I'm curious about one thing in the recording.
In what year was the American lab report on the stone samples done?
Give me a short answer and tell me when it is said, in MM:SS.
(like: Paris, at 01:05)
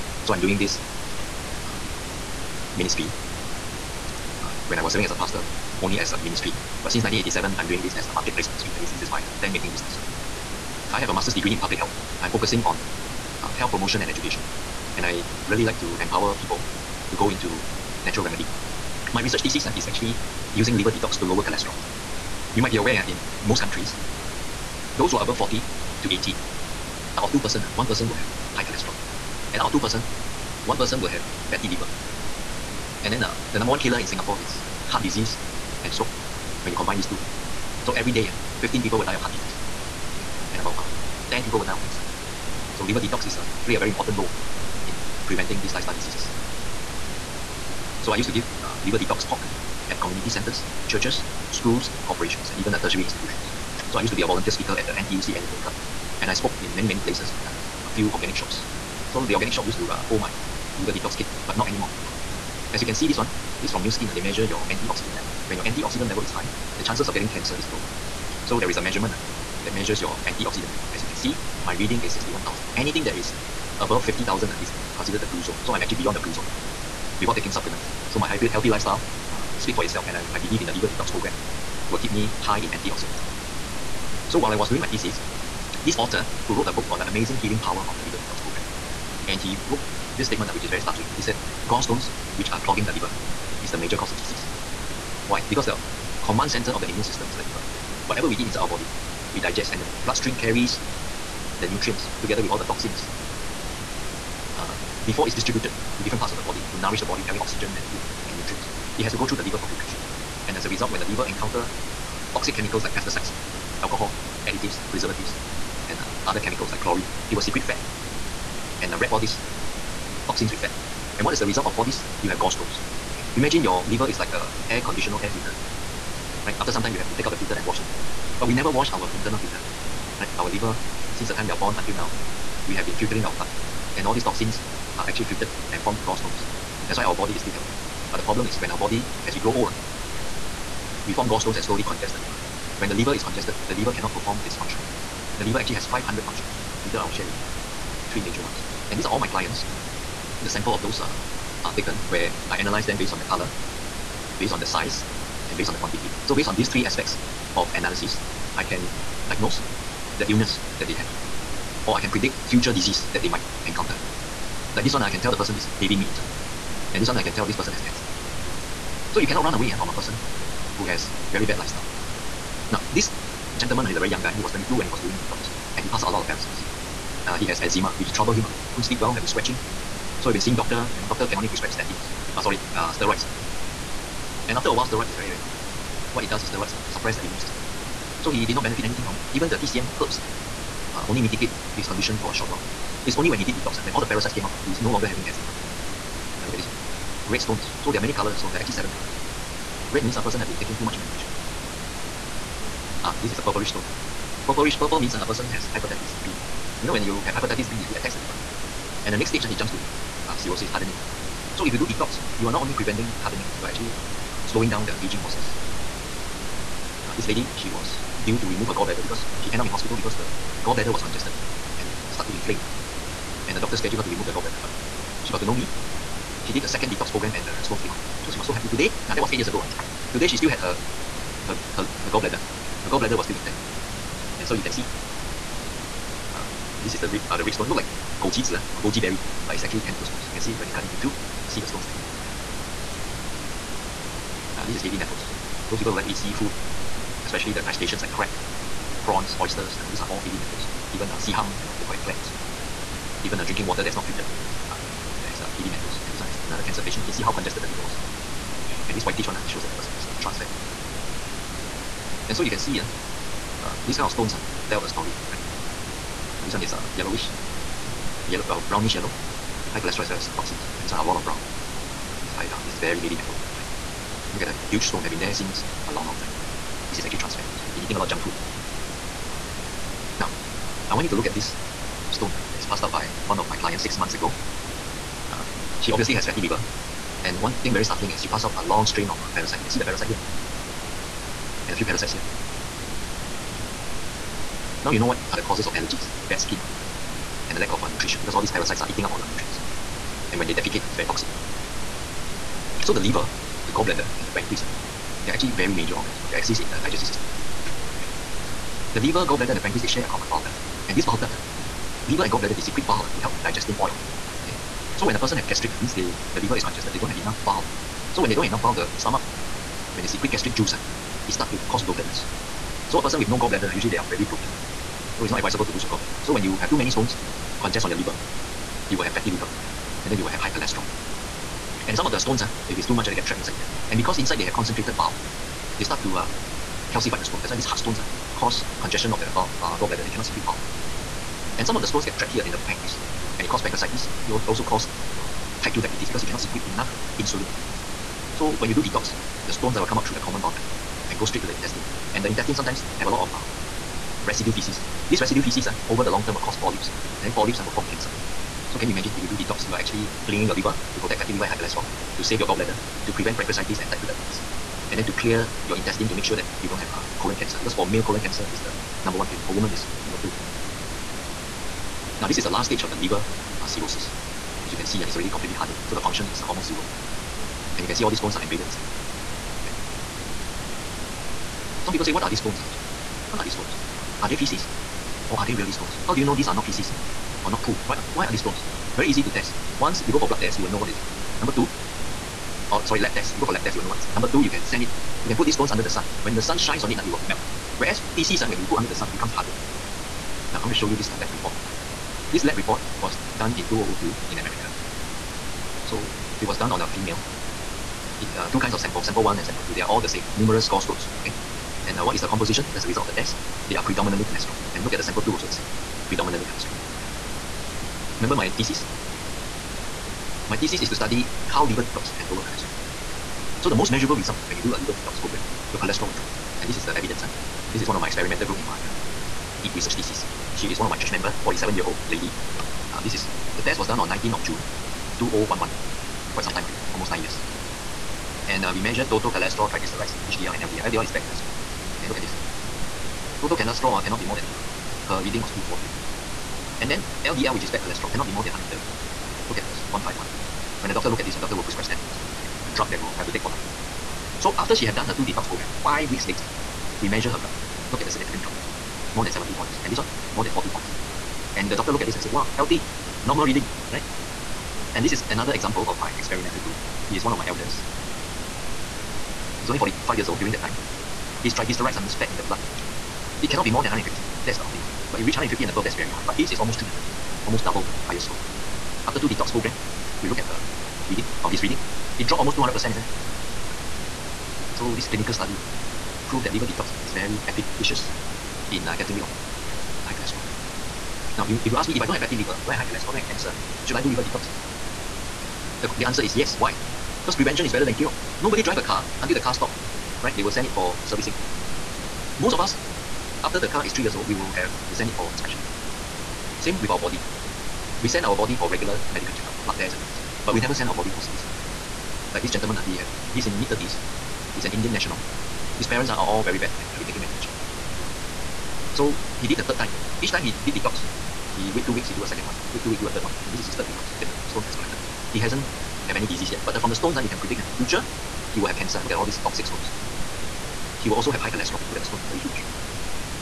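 2002, at 06:43.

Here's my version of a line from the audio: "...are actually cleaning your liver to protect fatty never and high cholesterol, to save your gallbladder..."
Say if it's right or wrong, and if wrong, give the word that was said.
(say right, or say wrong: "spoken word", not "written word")
wrong: "liver", not "never".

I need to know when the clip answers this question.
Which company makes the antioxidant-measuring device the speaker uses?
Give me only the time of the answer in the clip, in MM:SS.
01:03.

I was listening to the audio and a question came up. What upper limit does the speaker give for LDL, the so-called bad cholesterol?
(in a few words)
130.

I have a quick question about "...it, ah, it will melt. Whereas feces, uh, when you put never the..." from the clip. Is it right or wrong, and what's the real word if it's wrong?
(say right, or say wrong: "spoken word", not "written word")
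wrong: "under", not "never".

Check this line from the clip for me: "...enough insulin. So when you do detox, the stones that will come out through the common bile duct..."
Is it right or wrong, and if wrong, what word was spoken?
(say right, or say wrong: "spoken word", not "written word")
right.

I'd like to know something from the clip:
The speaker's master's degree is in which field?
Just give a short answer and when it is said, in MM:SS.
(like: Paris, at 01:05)
Public health, at 00:11.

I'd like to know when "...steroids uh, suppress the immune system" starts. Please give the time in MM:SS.
03:06.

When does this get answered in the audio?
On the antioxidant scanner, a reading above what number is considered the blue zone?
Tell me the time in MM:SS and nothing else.
01:14.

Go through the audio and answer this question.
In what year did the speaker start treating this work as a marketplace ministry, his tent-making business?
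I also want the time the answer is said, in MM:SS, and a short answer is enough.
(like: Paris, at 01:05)
1987, at 00:07.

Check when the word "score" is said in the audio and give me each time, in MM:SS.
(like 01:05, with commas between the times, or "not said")
07:58.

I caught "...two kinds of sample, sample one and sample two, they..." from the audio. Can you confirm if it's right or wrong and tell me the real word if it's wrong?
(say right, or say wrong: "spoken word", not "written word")
right.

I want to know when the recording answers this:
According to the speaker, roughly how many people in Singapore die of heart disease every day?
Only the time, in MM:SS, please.
00:38.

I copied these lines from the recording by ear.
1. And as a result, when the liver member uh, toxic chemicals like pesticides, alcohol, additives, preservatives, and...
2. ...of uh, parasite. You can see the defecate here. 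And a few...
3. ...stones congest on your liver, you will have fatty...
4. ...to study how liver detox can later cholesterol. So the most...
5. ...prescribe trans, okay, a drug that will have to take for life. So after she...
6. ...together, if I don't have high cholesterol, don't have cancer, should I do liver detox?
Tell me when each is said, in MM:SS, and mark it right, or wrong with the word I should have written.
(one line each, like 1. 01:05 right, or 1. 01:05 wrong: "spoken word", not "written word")
1. 01:50 wrong: "encounter", not "member"
2. 04:49 wrong: "parasite", not "defecate"
3. 05:26 right
4. 07:00 wrong: "lower", not "later"
5. 07:31 wrong: "statins", not "trans"
6. 08:12 wrong: "liver", not "together".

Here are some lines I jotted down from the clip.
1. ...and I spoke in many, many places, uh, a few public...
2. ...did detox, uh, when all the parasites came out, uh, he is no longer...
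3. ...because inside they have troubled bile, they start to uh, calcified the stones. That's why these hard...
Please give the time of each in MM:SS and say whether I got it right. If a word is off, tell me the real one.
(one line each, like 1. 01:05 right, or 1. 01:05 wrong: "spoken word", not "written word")
1. 00:56 wrong: "organic", not "public"
2. 03:13 right
3. 05:33 wrong: "concentrated", not "troubled".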